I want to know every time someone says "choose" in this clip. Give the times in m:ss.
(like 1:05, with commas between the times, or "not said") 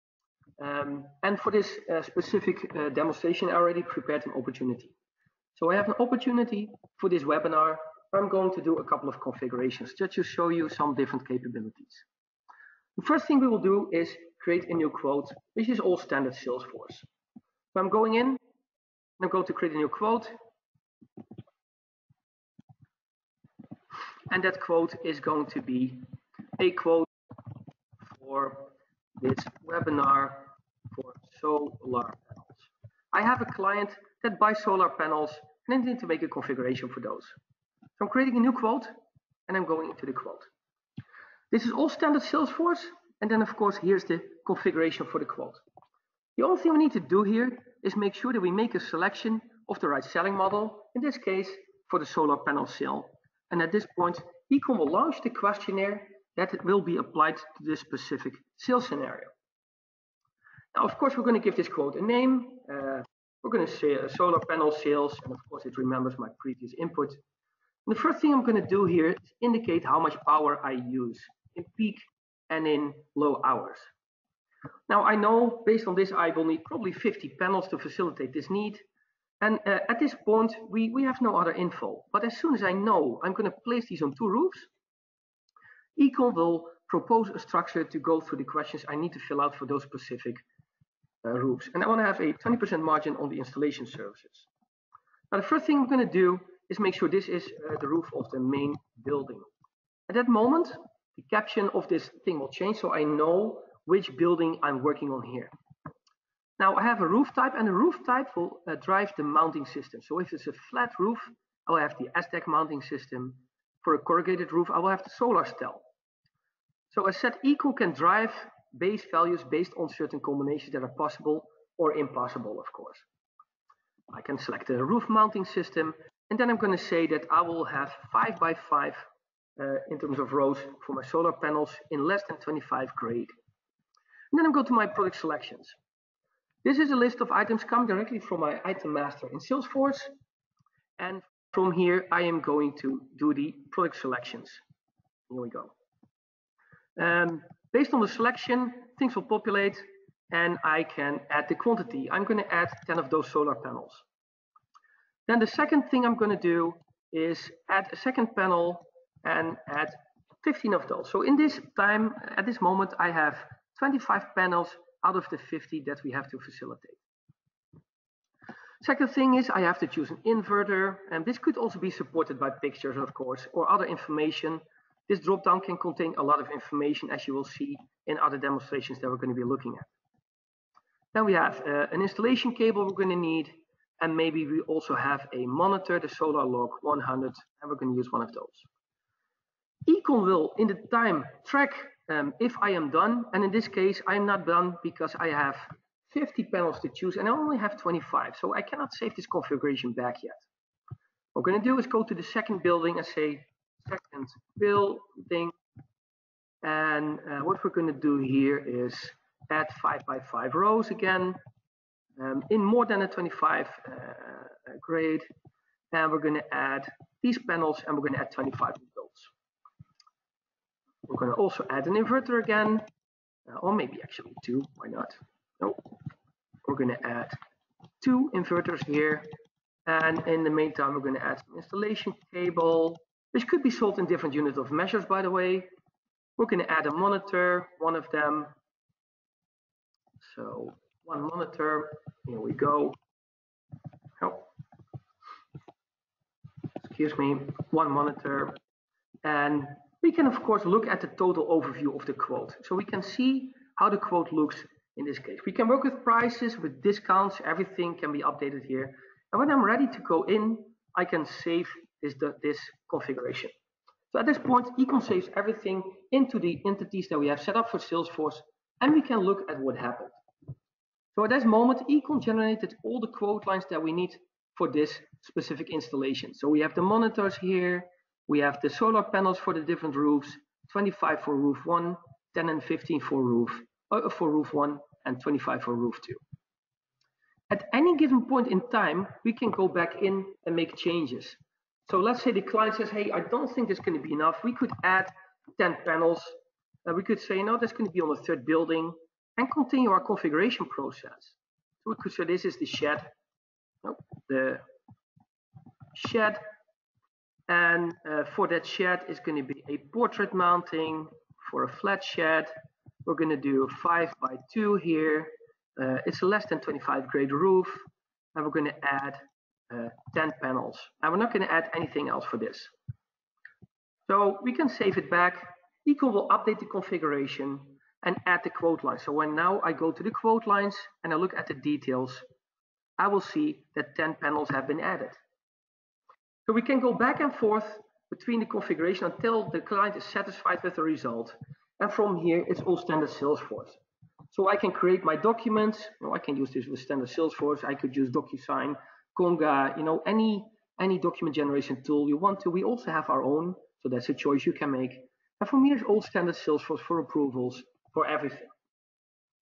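2:49, 3:16.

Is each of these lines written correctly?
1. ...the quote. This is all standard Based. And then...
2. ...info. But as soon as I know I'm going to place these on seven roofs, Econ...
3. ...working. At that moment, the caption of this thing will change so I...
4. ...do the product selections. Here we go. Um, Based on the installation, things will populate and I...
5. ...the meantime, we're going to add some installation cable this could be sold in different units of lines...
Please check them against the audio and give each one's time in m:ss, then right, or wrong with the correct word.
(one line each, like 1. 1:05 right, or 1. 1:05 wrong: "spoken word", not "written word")
1. 0:40 wrong: "Salesforce", not "Based"
2. 1:21 wrong: "two", not "seven"
3. 1:39 wrong: "building", not "working"
4. 2:23 wrong: "selection", not "installation"
5. 3:50 wrong: "measures", not "lines".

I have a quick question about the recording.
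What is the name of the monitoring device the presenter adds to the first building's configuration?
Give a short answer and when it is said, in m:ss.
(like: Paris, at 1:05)
Solar Log 100, at 3:06.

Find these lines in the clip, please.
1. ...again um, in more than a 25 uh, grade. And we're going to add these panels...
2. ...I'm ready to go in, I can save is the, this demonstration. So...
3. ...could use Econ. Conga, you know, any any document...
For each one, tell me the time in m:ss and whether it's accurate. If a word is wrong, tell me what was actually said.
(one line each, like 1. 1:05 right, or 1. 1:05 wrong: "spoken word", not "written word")
1. 3:30 right
2. 4:19 wrong: "configuration", not "demonstration"
3. 5:47 wrong: "DocuSign", not "Econ".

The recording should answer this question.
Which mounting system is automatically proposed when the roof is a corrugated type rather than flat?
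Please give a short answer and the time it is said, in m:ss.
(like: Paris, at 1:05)
solar stell, at 1:55.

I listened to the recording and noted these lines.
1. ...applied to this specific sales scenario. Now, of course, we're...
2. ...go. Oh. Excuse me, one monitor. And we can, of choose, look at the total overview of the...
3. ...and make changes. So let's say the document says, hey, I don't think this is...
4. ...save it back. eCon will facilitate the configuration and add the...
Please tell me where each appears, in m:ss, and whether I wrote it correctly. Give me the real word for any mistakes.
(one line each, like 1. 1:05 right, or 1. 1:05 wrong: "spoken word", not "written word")
1. 0:56 right
2. 4:02 wrong: "course", not "choose"
3. 4:50 wrong: "client", not "document"
4. 5:24 wrong: "update", not "facilitate".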